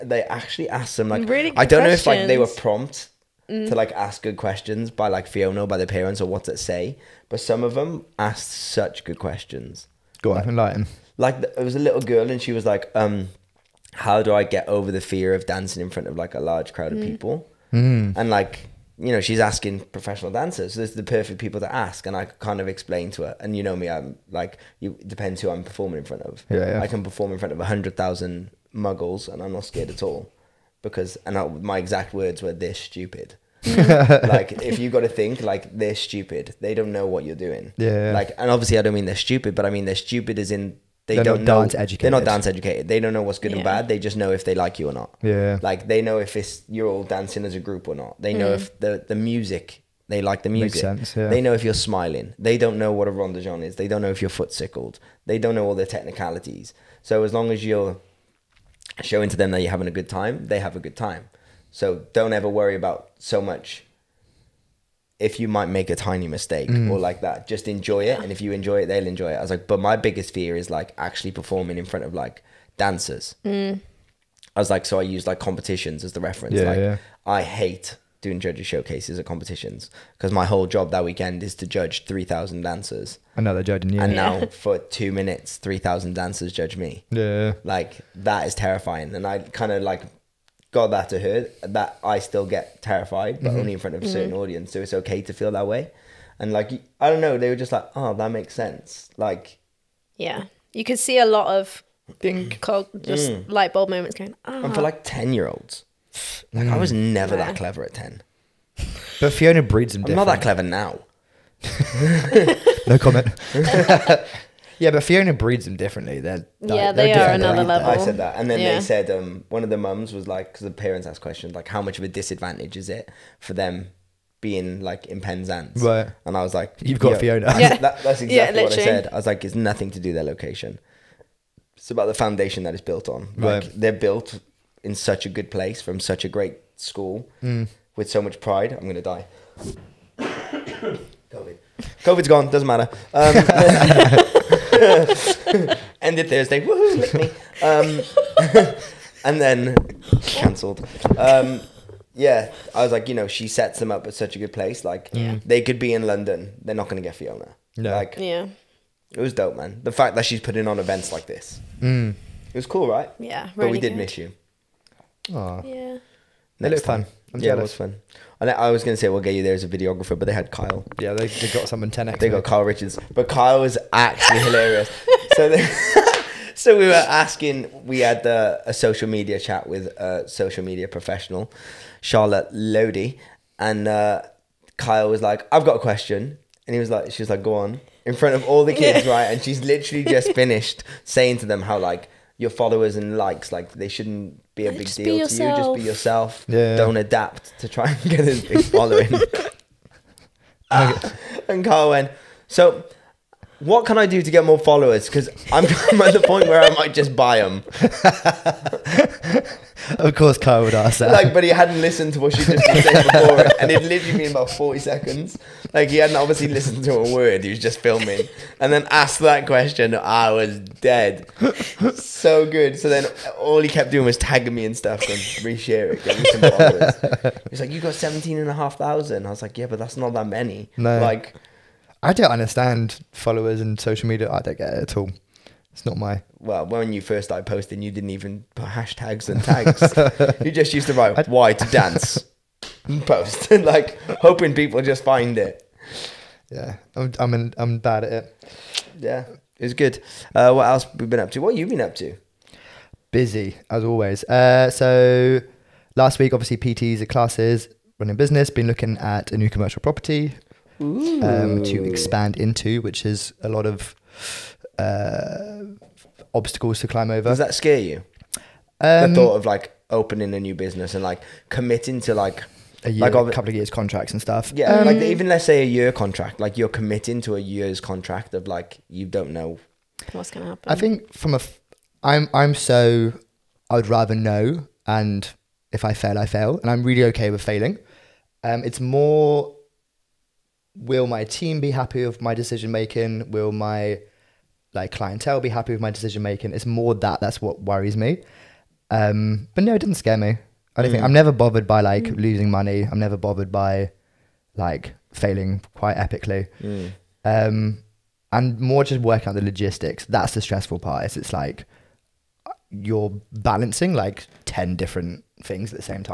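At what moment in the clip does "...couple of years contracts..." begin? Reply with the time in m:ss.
4:33.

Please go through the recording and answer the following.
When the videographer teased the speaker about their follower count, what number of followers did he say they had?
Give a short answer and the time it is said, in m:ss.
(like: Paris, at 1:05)
17,500, at 3:47.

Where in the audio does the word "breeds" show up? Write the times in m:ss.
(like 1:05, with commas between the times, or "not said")
1:49, 1:55.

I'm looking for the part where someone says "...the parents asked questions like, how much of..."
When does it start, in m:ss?
2:00.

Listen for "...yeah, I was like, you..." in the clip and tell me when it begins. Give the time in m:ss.
2:32.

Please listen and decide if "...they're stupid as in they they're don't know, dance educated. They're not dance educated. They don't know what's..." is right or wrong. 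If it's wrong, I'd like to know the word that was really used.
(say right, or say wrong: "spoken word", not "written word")
right.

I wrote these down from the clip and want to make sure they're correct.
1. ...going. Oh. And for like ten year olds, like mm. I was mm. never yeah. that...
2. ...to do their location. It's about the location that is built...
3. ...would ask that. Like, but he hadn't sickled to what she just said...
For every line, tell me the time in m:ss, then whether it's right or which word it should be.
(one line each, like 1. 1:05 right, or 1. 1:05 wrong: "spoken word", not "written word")
1. 1:44 right
2. 2:09 wrong: "foundation", not "location"
3. 3:30 wrong: "listened", not "sickled".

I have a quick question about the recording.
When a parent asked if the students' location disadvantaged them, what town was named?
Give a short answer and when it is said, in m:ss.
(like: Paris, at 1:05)
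Penzance, at 2:05.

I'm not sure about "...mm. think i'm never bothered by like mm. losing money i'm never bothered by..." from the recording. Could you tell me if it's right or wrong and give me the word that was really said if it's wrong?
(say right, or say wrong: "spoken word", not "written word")
right.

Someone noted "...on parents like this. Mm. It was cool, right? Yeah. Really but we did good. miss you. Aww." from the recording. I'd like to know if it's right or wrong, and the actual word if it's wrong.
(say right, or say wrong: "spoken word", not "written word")
wrong: "events", not "parents".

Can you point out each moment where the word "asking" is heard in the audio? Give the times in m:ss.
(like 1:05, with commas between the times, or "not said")
0:19, 2:57.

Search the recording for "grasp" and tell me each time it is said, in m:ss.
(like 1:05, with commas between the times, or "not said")
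not said.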